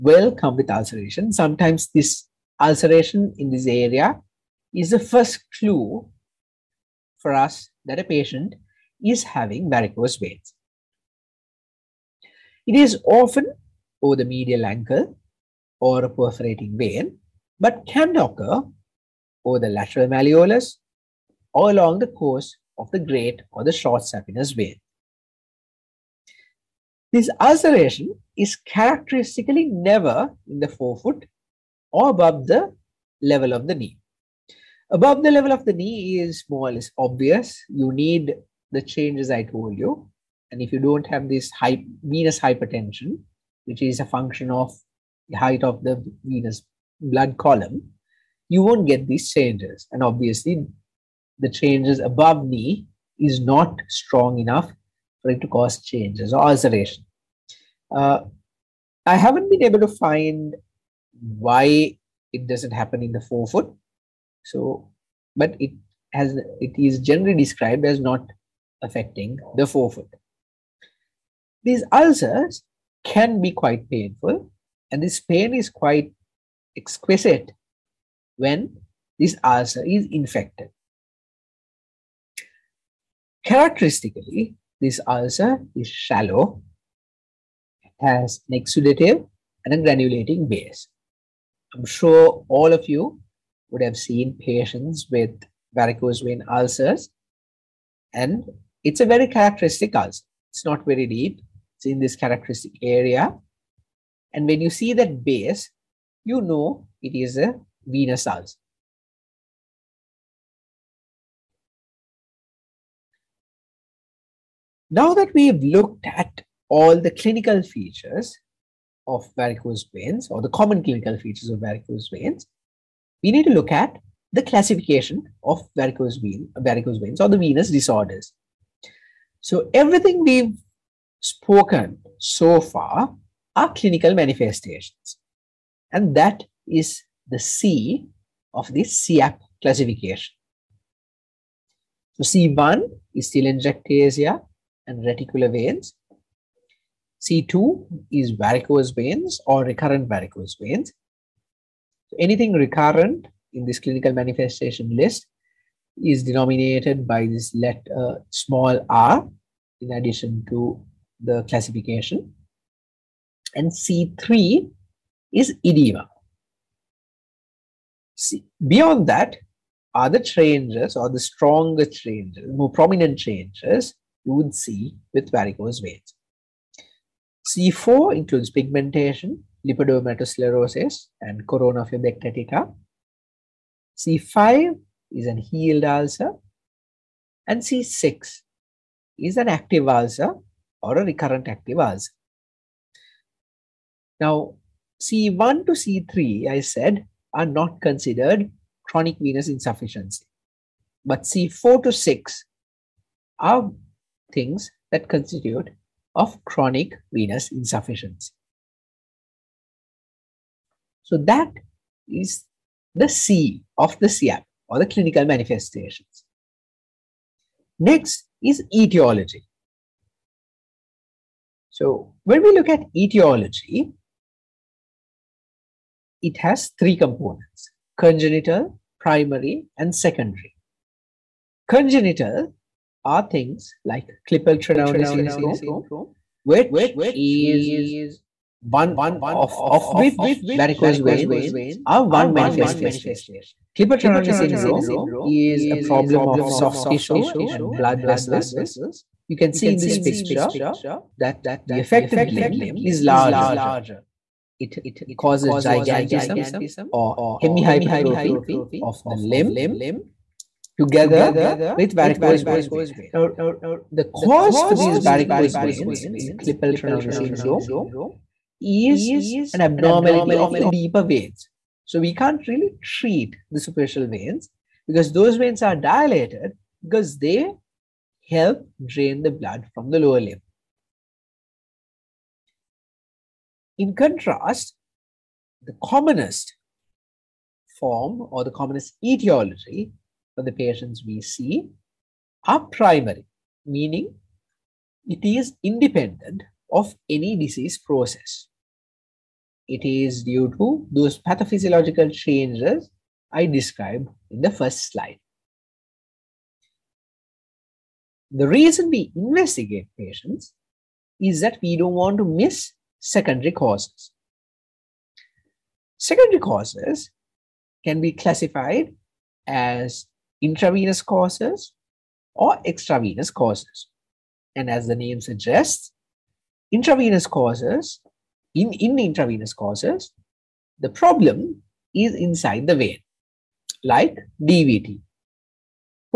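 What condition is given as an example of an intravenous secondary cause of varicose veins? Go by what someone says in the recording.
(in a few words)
DVT.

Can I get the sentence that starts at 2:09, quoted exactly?
So everything we've spoken so far are clinical manifestations.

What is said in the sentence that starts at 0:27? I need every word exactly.
This ulceration is characteristically never in the forefoot or above the level of the knee.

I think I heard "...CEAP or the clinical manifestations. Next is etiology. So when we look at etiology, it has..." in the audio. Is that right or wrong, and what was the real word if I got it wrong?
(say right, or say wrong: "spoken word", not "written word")
right.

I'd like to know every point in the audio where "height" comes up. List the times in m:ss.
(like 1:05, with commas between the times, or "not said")
0:45.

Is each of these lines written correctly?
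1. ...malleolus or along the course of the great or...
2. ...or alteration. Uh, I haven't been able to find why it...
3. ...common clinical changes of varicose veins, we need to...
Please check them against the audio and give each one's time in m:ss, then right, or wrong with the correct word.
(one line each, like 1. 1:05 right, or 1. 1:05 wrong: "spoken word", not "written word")
1. 0:20 right
2. 0:56 right
3. 2:00 wrong: "features", not "changes".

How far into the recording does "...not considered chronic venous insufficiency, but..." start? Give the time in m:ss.
3:17.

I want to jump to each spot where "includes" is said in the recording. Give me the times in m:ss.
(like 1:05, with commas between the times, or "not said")
2:58.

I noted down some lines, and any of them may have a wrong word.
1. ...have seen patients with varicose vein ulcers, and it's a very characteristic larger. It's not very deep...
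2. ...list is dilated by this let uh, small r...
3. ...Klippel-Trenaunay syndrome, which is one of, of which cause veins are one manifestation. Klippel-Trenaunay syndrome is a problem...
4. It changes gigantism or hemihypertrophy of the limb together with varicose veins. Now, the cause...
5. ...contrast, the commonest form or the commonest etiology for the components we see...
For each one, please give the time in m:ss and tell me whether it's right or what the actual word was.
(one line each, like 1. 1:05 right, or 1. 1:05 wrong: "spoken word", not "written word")
1. 1:33 wrong: "ulcer", not "larger"
2. 2:34 wrong: "denominated", not "dilated"
3. 3:54 wrong: "varicose", not "cause"
4. 4:14 wrong: "causes", not "changes"
5. 4:43 wrong: "patients", not "components".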